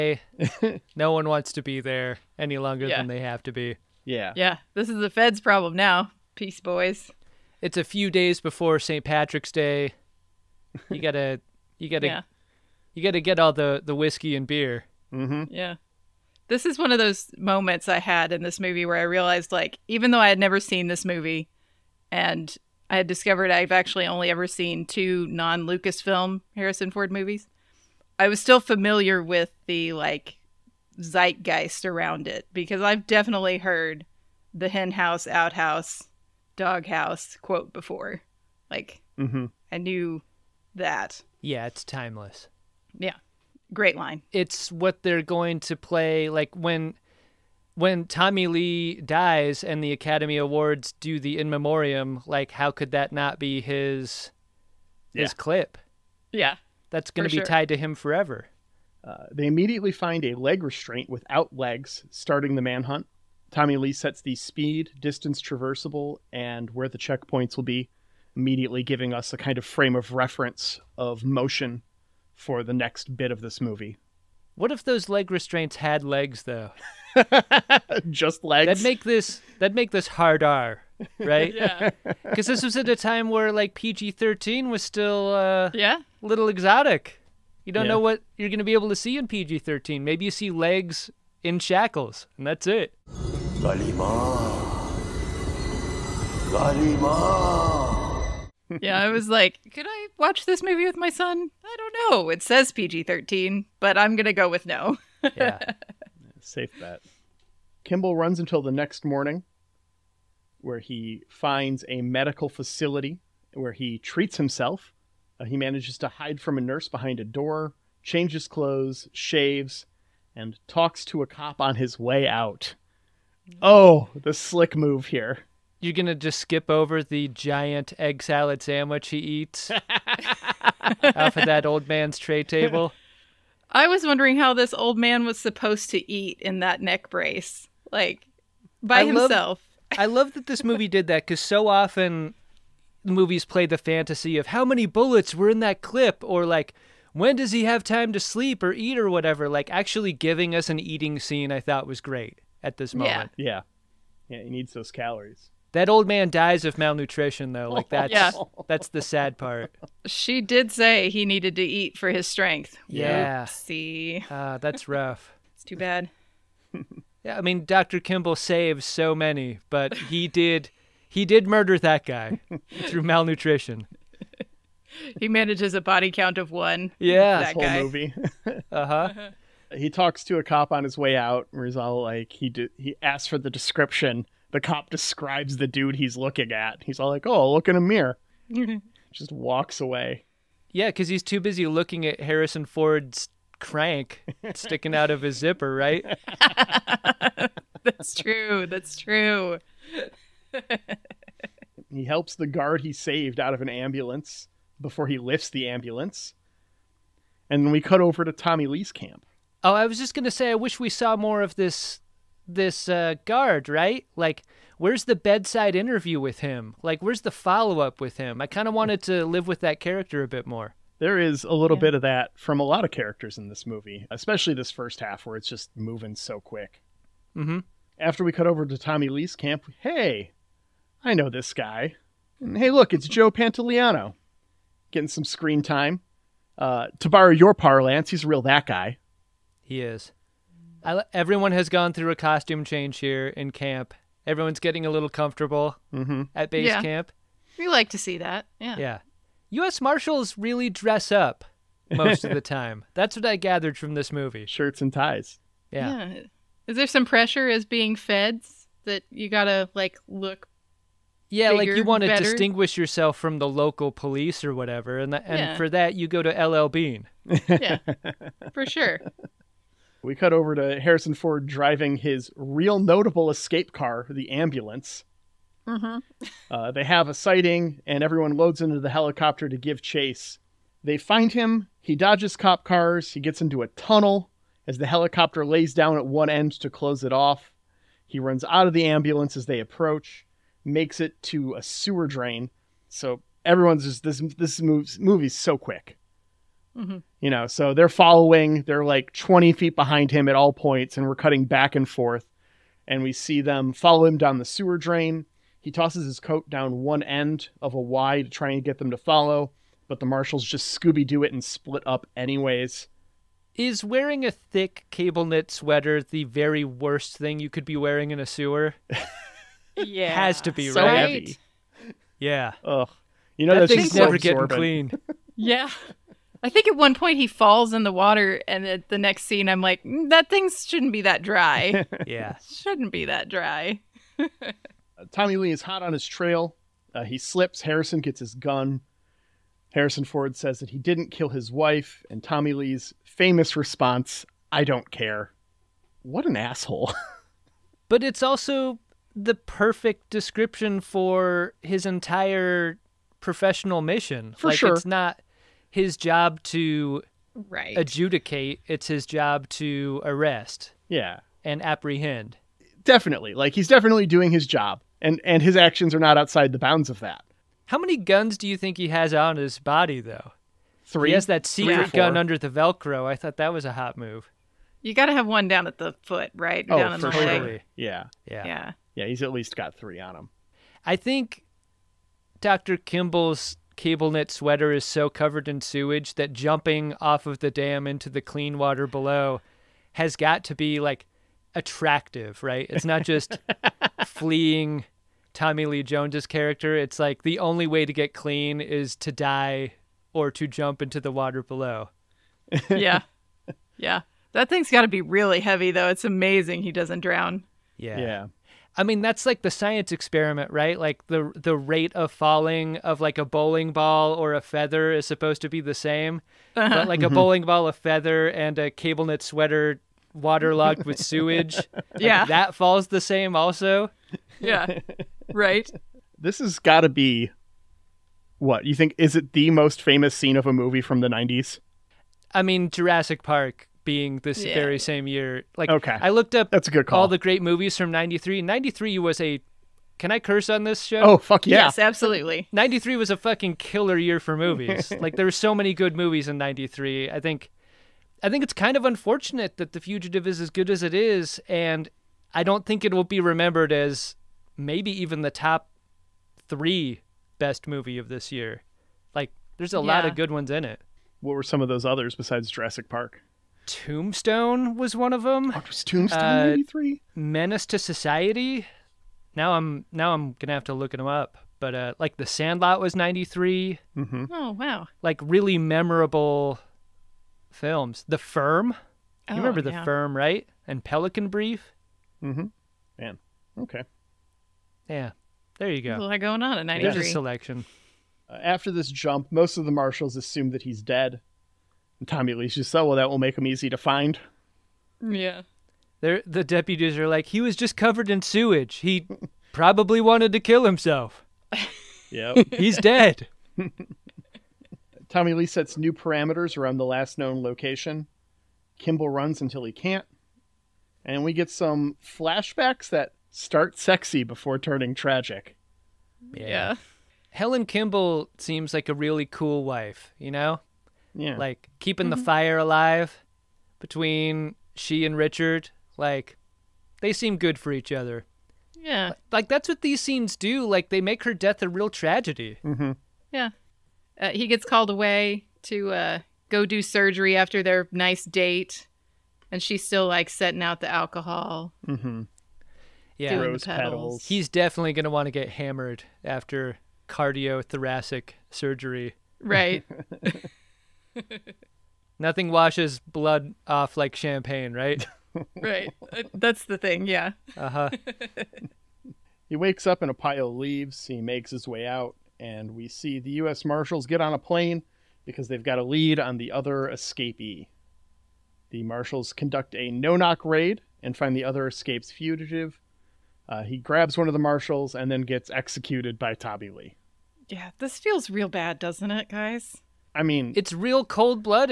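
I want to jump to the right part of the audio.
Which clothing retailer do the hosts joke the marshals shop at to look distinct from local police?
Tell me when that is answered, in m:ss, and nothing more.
4:26.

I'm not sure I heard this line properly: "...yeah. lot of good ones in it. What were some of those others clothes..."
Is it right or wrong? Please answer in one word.
wrong.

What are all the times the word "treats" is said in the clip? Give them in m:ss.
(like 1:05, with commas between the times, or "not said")
1:53.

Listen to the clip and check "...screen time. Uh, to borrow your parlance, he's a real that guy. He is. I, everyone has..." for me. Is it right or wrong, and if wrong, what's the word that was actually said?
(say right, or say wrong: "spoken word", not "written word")
right.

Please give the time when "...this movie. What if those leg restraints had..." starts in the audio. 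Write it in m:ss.
1:13.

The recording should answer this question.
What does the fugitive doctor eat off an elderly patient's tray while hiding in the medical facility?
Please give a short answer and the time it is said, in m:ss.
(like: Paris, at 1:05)
Egg salad sandwich, at 2:07.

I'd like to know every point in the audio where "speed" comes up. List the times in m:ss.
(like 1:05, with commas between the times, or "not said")
1:04.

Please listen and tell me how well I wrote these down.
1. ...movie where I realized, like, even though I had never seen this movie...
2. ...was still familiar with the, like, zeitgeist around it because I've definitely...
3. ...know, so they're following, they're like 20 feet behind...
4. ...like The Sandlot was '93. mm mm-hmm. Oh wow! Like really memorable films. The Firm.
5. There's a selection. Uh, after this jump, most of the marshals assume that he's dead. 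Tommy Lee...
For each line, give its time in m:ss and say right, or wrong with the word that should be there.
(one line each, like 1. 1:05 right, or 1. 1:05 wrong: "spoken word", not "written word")
1. 0:18 right
2. 0:28 right
3. 4:57 right
4. 7:51 right
5. 8:06 right.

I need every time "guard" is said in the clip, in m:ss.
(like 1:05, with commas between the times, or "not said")
3:22, 3:33.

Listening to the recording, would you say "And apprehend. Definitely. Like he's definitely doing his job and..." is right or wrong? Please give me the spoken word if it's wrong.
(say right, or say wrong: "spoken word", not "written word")
right.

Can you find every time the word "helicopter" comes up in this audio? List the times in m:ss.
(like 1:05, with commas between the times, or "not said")
4:38, 4:44.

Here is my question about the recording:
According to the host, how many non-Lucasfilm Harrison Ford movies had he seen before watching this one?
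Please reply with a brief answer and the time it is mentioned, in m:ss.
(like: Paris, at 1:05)
2, at 0:24.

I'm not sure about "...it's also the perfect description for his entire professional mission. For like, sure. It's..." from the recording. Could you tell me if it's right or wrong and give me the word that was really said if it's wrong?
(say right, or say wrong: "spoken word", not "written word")
right.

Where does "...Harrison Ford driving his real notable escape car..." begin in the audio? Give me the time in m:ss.
4:30.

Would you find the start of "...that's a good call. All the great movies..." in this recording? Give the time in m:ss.
7:16.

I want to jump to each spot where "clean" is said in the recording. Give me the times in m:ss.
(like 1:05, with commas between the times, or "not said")
5:24, 6:28, 6:38.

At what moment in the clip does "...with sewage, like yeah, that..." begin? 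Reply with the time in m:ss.
7:00.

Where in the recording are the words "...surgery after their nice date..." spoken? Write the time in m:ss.
8:56.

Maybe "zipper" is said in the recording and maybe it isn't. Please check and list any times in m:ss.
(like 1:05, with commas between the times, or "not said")
3:15.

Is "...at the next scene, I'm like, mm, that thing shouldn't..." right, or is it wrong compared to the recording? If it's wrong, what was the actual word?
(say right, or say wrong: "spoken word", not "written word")
right.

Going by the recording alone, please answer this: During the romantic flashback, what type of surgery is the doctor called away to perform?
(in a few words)
Cardiothoracic surgery.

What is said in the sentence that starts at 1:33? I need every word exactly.
Galima, Galima yeah, I was like, could I watch this movie with my son?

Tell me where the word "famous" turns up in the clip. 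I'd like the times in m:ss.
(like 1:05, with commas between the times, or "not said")
5:43, 7:09.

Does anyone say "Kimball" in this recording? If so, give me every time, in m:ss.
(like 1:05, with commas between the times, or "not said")
1:47, 2:47, 6:22, 8:28, 8:37.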